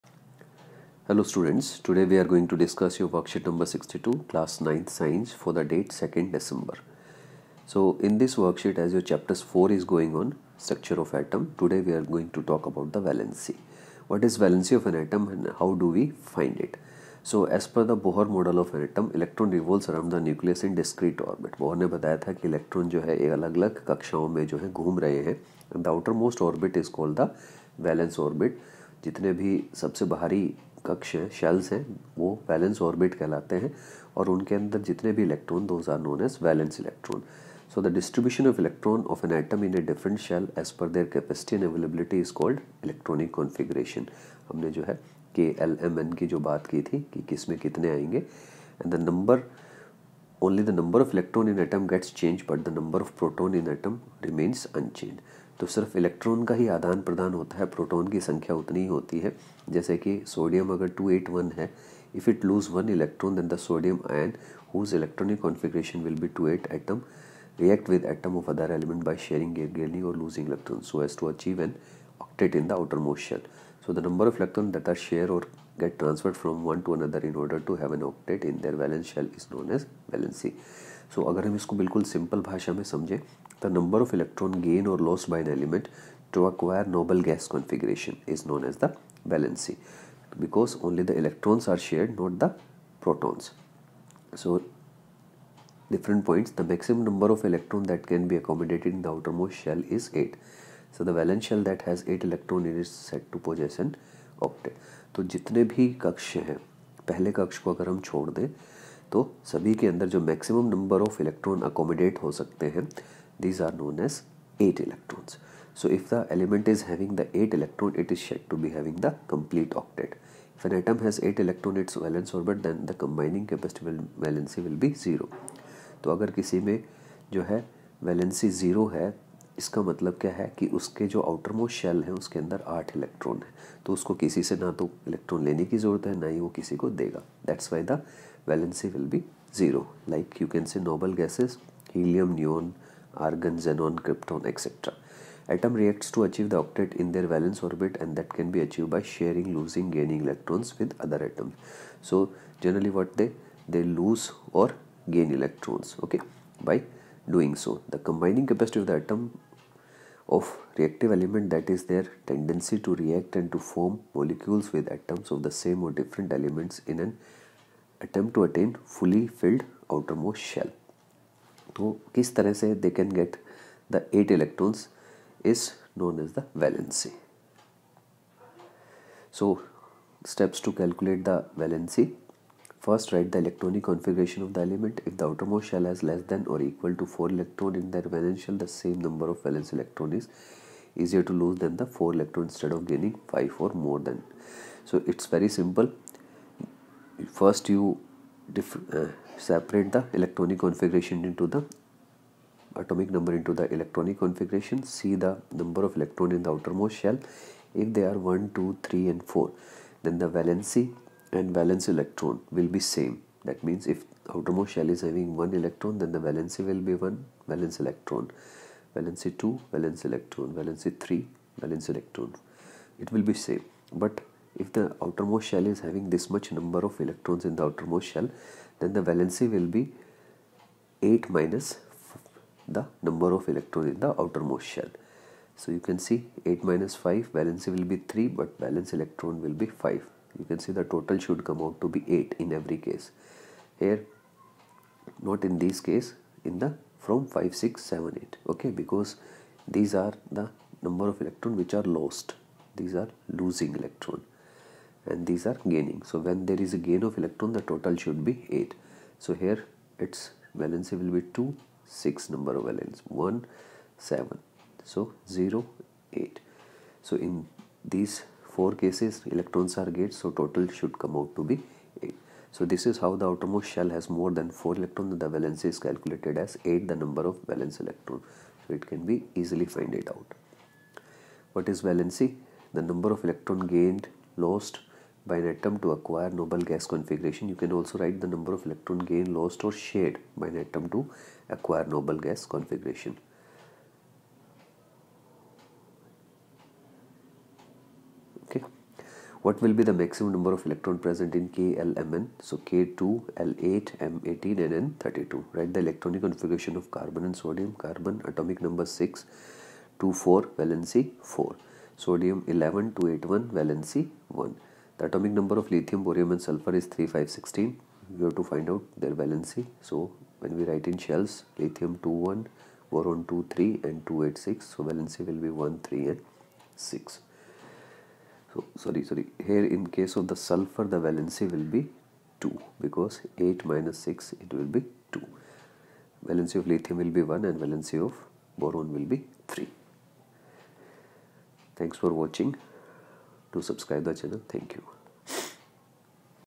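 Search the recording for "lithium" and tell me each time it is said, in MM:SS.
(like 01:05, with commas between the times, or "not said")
05:15, 05:21, 05:36.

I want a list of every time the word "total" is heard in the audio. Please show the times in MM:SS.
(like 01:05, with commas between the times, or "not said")
04:00, 04:17, 04:30.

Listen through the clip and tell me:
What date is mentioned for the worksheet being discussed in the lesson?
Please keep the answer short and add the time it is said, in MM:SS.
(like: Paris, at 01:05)
2nd December, at 00:05.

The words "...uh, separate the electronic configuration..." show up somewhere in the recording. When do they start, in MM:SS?
03:19.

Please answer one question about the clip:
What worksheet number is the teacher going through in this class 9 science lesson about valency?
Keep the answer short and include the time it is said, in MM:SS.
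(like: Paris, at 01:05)
62, at 00:03.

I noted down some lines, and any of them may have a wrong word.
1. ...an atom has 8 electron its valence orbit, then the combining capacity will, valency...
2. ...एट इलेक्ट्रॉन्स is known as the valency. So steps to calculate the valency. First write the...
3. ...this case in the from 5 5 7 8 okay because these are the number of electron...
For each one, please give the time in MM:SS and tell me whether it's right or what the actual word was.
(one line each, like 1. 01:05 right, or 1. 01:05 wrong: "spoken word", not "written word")
1. 02:00 right
2. 02:54 right
3. 04:05 wrong: "6", not "5".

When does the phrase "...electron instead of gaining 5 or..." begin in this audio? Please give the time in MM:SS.
03:12.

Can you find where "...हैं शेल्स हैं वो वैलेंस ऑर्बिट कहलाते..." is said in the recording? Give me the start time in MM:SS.
00:31.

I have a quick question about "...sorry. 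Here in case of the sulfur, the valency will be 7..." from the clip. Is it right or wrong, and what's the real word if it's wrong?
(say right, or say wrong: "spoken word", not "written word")
wrong: "2", not "7".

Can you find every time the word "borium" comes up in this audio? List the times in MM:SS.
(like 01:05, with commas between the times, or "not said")
05:16.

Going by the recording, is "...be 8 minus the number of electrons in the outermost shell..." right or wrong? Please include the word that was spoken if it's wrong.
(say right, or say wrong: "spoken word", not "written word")
right.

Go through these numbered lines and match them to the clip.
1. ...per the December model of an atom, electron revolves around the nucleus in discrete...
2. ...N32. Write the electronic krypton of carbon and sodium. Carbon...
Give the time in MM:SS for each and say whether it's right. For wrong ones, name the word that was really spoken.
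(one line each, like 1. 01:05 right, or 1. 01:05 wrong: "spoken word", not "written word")
1. 00:17 wrong: "Bohr", not "December"
2. 05:04 wrong: "configuration", not "krypton".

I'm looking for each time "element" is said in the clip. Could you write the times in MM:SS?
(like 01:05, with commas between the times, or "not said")
01:25, 01:56, 02:41, 02:46, 03:04.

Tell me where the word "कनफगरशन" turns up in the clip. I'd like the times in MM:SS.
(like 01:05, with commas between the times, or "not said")
00:43, 01:05.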